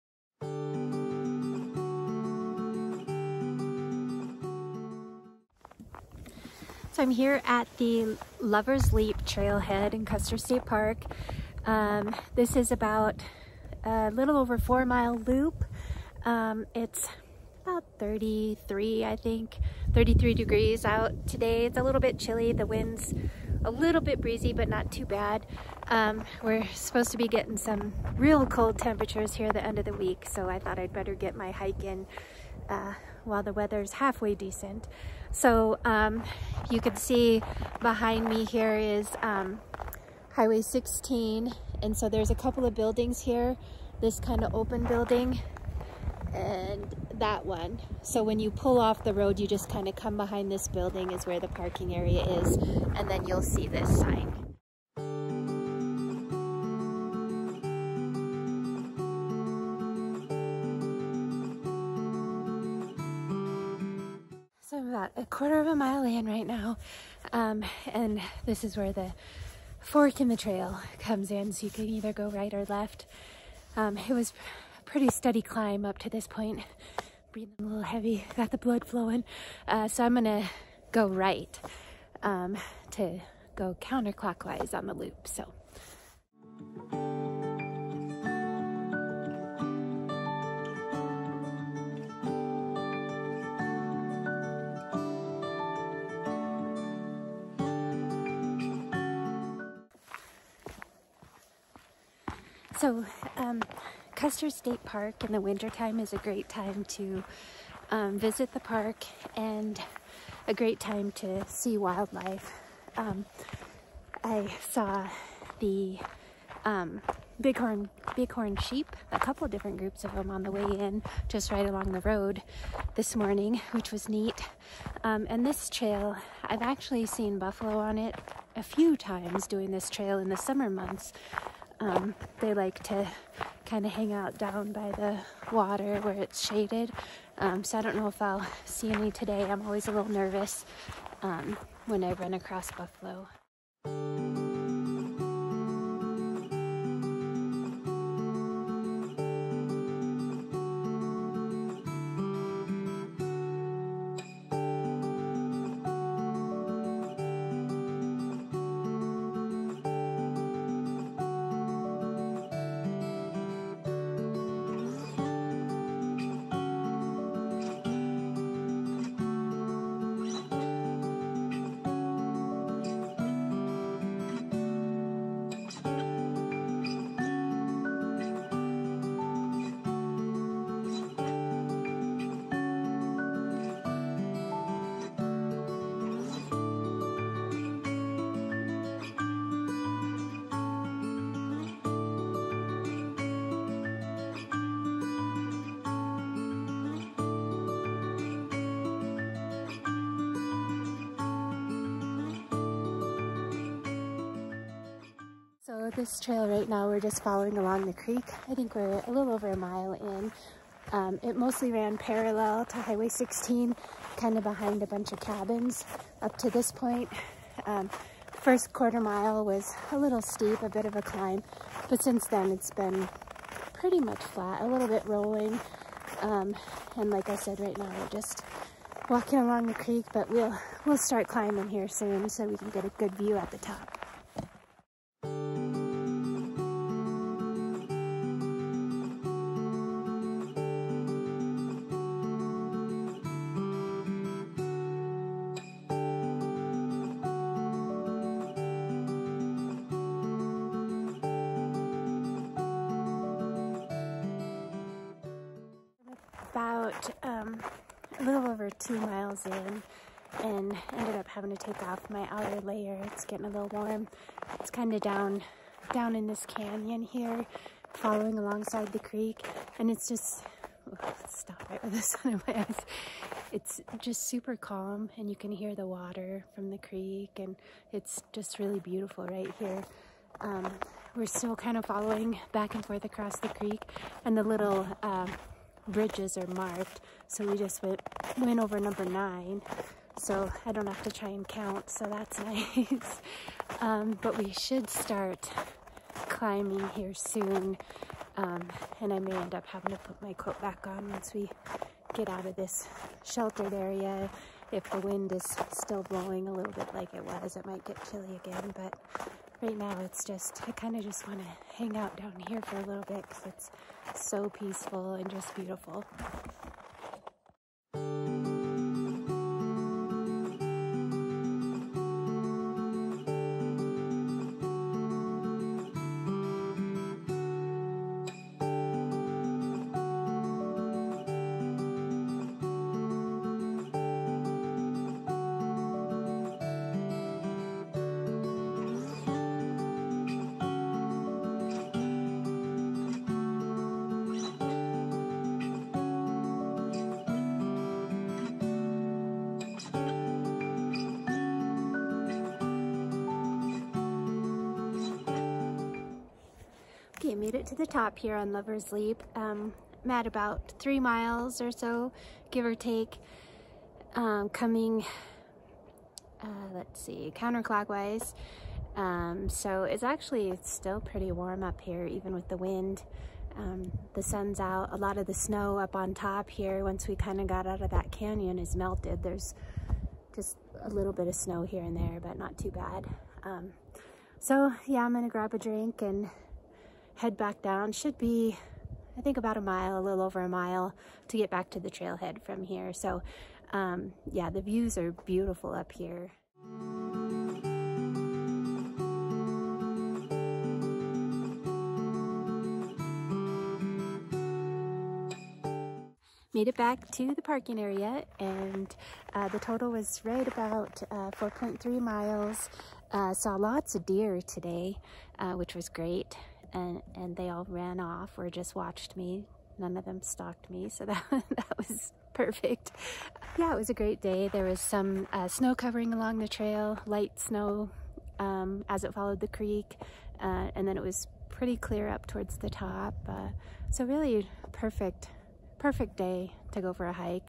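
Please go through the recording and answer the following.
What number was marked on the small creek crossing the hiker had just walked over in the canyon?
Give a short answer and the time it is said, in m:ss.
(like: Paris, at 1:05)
9, at 4:48.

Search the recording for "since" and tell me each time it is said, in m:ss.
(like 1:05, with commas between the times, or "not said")
3:42.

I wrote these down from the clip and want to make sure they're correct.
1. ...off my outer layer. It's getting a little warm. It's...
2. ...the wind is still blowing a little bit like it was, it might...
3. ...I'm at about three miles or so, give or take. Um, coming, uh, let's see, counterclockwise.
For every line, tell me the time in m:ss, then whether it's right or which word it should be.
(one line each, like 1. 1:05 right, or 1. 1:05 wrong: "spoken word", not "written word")
1. 4:21 right
2. 5:04 right
3. 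6:00 right.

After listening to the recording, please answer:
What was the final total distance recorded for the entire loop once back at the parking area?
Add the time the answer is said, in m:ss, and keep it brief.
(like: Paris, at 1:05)
4.3 miles, at 6:51.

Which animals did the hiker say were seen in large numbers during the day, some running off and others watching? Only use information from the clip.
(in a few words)
Deer.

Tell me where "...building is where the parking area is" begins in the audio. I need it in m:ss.
0:50.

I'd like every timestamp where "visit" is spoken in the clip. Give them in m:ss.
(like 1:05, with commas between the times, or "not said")
1:48.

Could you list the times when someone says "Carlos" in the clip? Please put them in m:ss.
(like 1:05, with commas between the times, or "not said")
not said.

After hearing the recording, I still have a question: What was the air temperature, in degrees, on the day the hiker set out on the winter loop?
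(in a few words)
33.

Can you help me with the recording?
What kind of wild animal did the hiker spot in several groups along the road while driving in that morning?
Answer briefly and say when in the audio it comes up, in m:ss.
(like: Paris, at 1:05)
Bighorn sheep, at 1:58.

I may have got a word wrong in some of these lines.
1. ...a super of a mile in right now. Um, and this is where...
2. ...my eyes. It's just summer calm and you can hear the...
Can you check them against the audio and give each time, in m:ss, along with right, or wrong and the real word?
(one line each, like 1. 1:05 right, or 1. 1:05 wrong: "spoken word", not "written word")
1. 1:05 wrong: "quarter", not "super"
2. 4:32 wrong: "super", not "summer".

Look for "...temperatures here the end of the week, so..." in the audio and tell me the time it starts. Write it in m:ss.
0:28.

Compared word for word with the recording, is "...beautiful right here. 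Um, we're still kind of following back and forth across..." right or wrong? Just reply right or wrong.
right.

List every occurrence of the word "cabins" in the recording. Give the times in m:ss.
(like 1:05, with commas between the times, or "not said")
3:35.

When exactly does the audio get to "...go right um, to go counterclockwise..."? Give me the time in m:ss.
1:20.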